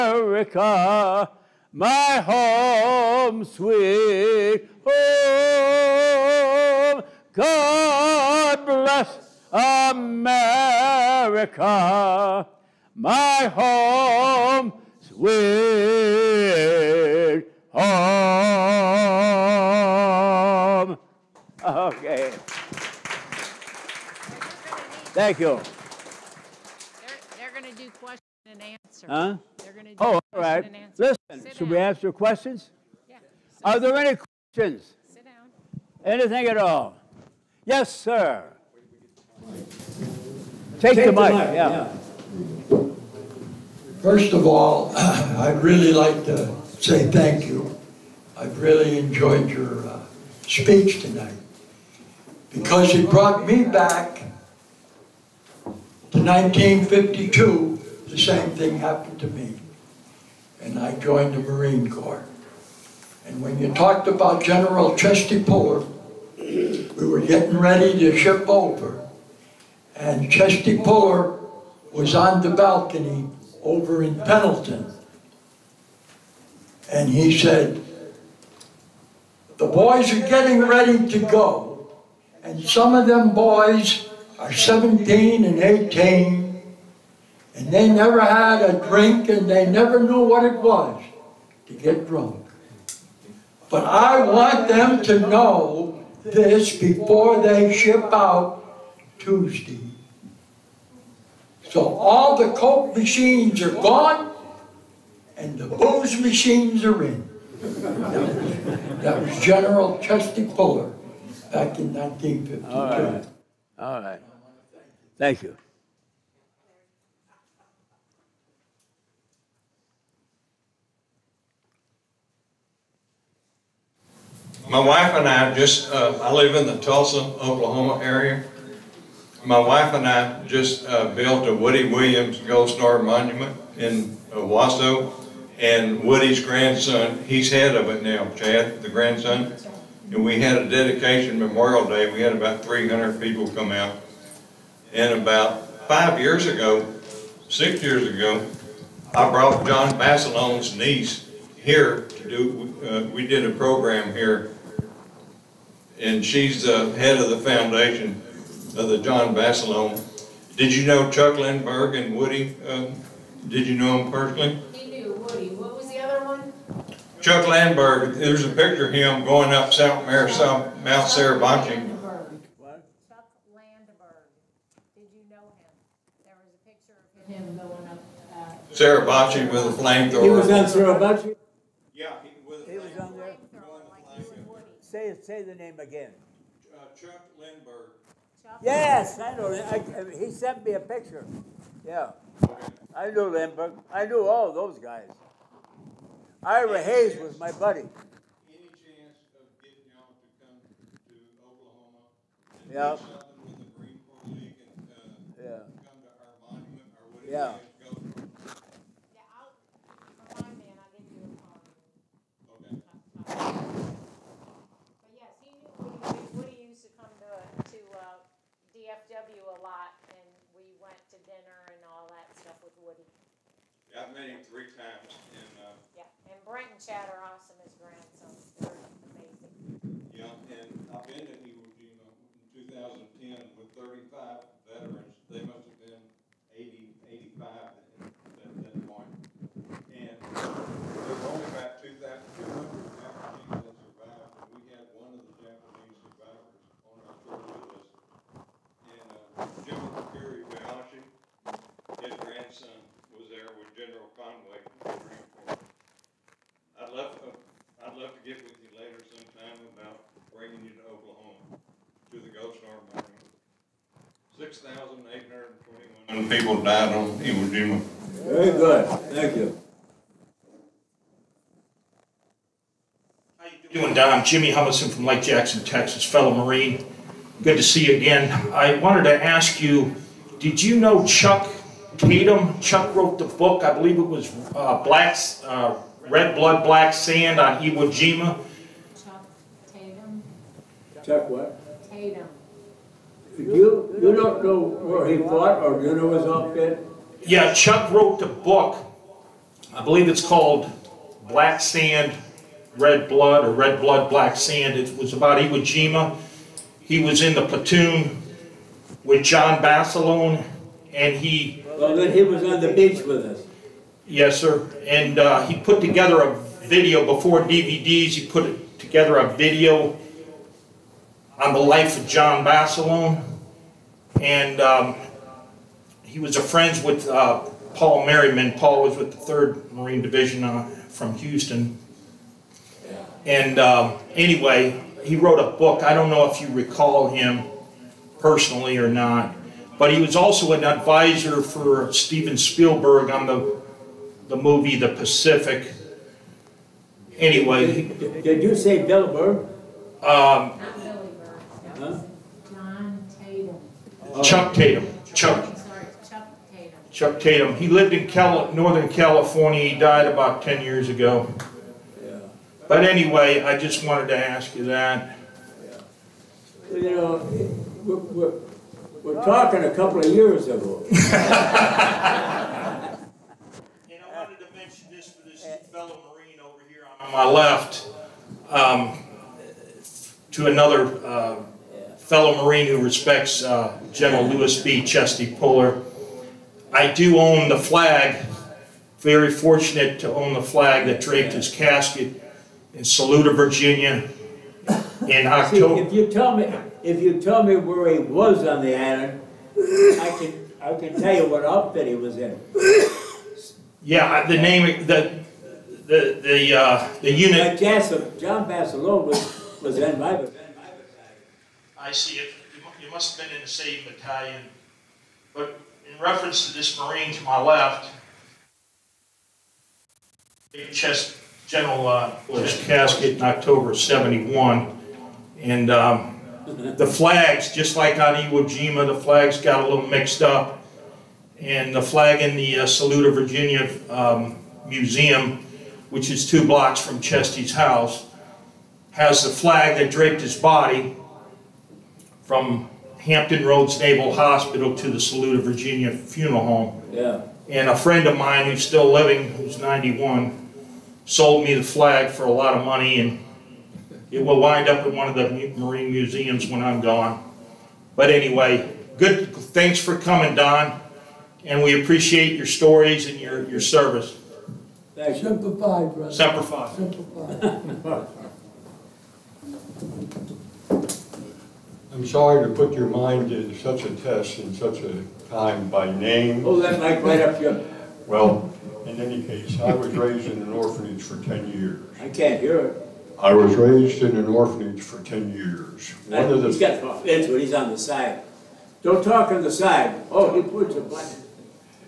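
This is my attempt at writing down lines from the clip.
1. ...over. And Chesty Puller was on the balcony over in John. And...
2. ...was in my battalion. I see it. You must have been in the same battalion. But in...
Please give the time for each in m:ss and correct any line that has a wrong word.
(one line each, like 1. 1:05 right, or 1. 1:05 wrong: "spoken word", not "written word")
1. 1:08 wrong: "Pendleton", not "John"
2. 6:49 right.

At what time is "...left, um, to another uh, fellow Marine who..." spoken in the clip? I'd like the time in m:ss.
6:17.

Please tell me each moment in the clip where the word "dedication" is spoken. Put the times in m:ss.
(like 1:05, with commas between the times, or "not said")
2:20.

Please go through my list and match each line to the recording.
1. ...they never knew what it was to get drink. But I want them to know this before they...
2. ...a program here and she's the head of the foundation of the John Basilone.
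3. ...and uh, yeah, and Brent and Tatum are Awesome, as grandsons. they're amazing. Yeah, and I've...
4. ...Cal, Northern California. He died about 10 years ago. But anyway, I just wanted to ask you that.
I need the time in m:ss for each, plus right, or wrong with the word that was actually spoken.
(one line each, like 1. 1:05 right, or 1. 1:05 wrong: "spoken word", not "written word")
1. 1:29 wrong: "drunk", not "drink"
2. 2:33 right
3. 3:45 wrong: "Chad", not "Tatum"
4. 5:58 right.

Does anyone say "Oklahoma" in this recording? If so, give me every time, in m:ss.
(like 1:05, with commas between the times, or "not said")
2:07, 3:21.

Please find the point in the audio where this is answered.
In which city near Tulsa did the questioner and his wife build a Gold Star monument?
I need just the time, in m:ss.
2:14.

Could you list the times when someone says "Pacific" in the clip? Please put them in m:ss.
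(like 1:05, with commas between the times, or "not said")
5:44.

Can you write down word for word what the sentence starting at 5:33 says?
And um, anyway, he wrote a book.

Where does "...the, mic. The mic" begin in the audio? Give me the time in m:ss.
0:41.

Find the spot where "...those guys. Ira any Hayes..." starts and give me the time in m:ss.
3:14.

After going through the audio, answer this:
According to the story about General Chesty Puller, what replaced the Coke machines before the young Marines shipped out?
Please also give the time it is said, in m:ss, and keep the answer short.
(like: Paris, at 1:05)
booze machines, at 1:45.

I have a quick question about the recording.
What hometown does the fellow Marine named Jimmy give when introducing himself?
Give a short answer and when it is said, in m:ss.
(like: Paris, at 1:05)
Lake Jackson, Texas, at 4:35.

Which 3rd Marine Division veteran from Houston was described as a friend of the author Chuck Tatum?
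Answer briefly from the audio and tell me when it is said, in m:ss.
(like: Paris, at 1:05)
Paul Merriman, at 5:27.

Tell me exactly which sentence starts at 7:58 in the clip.
Well, in any case, I was raised in an orphanage for 10 years.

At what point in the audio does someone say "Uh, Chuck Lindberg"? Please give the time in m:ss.
3:06.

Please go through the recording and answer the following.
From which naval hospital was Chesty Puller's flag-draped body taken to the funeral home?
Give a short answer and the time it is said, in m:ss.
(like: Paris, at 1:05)
Hampton Roads Naval Hospital, at 7:22.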